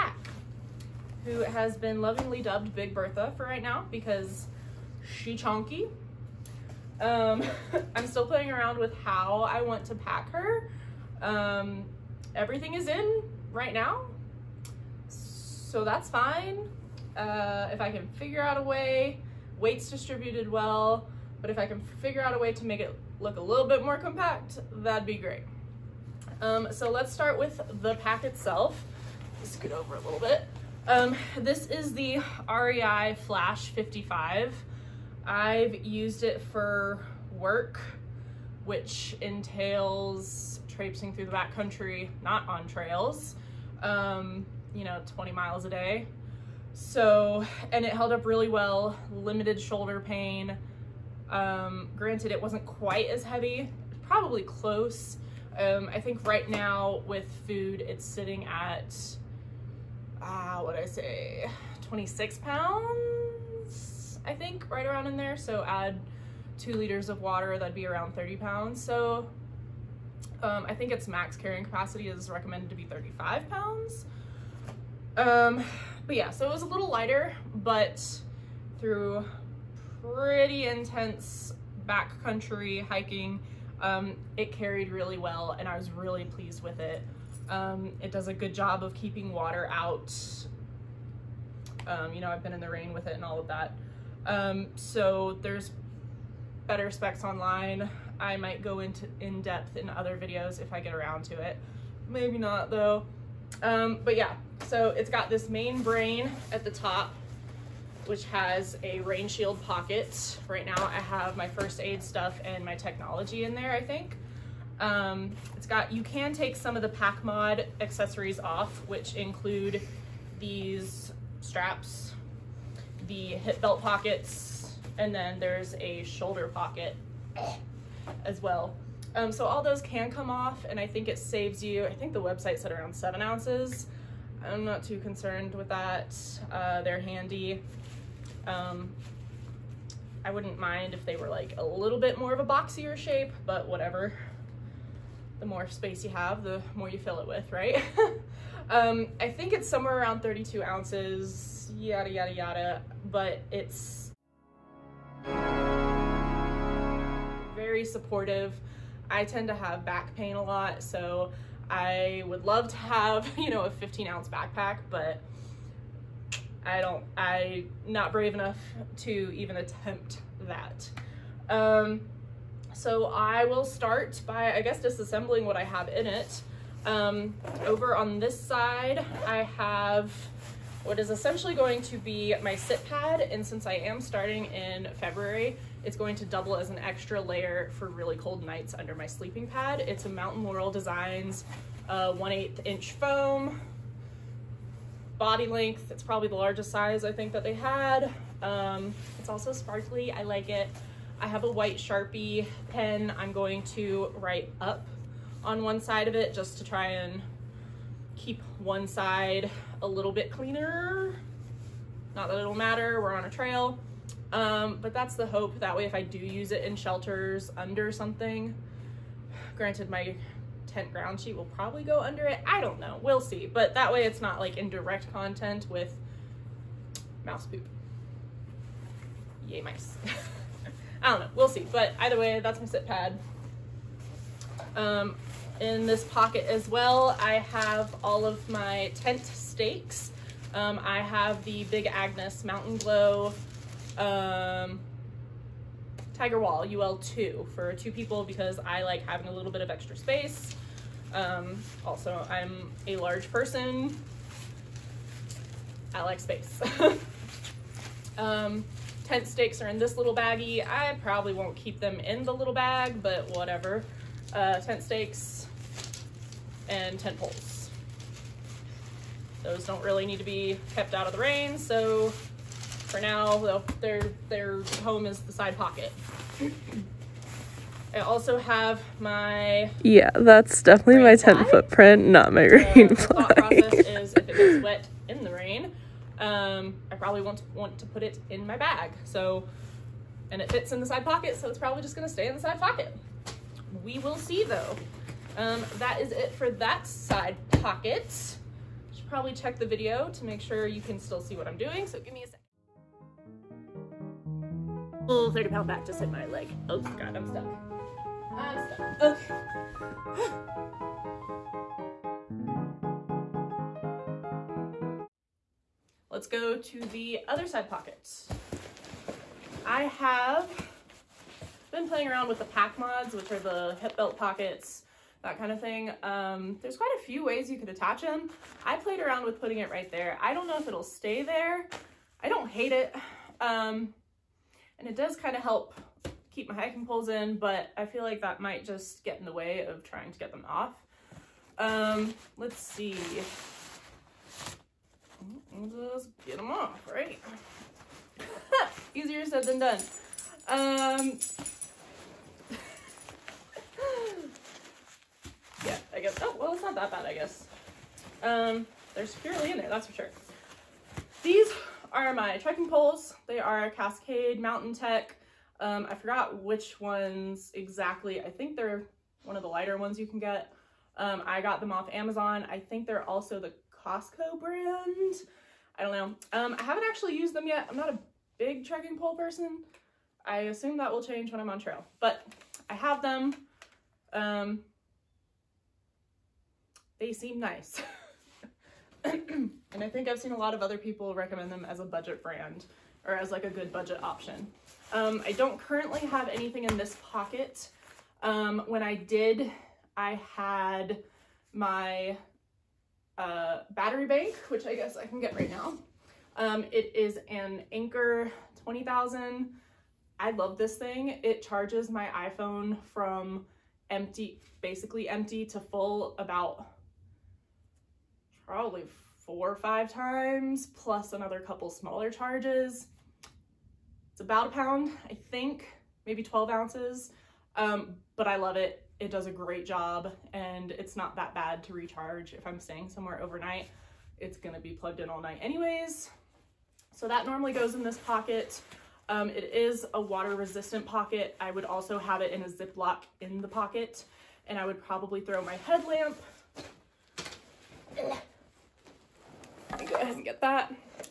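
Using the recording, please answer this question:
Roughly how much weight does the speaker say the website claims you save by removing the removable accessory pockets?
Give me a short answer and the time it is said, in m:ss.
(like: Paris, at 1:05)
7 ounces, at 2:12.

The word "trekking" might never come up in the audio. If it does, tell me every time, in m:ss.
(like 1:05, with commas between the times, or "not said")
6:02, 6:18.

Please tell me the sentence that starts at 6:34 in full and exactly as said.
Um, I don't currently have anything in this pocket.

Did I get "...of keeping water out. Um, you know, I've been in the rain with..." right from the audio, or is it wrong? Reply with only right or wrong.
right.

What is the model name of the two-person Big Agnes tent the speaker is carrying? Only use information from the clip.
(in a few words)
Tiger Wall UL2.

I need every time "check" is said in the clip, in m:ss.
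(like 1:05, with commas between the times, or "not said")
4:59.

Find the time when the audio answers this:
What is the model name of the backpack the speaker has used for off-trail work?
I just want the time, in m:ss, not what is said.
0:32.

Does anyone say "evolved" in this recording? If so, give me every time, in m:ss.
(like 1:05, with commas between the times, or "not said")
not said.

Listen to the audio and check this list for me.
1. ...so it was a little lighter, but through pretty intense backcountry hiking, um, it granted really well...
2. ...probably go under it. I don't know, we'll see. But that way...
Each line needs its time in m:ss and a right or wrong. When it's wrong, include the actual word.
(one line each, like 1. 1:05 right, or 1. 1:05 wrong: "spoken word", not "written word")
1. 1:16 wrong: "carried", not "granted"
2. 3:41 right.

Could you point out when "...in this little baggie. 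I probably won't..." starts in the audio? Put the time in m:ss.
4:19.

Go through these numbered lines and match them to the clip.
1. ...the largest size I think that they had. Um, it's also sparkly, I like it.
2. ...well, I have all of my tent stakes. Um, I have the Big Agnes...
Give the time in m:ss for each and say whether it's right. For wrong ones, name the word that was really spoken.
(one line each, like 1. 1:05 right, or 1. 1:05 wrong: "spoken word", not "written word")
1. 3:16 right
2. 3:56 right.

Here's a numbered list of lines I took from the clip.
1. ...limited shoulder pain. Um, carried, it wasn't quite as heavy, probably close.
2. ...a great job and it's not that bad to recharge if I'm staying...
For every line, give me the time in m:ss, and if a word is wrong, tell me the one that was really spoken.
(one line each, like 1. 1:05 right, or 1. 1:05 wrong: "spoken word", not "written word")
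1. 0:49 wrong: "granted", not "carried"
2. 7:09 right.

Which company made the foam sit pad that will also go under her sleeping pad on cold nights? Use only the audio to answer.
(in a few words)
Mountain Laurel Designs.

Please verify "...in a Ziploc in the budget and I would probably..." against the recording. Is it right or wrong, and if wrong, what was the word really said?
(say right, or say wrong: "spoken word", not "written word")
wrong: "pocket", not "budget".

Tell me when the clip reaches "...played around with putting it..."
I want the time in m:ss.
5:28.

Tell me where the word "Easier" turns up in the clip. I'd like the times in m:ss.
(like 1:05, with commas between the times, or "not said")
5:48.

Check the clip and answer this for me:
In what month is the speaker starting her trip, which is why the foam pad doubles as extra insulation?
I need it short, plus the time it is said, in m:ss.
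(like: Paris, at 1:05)
February, at 3:04.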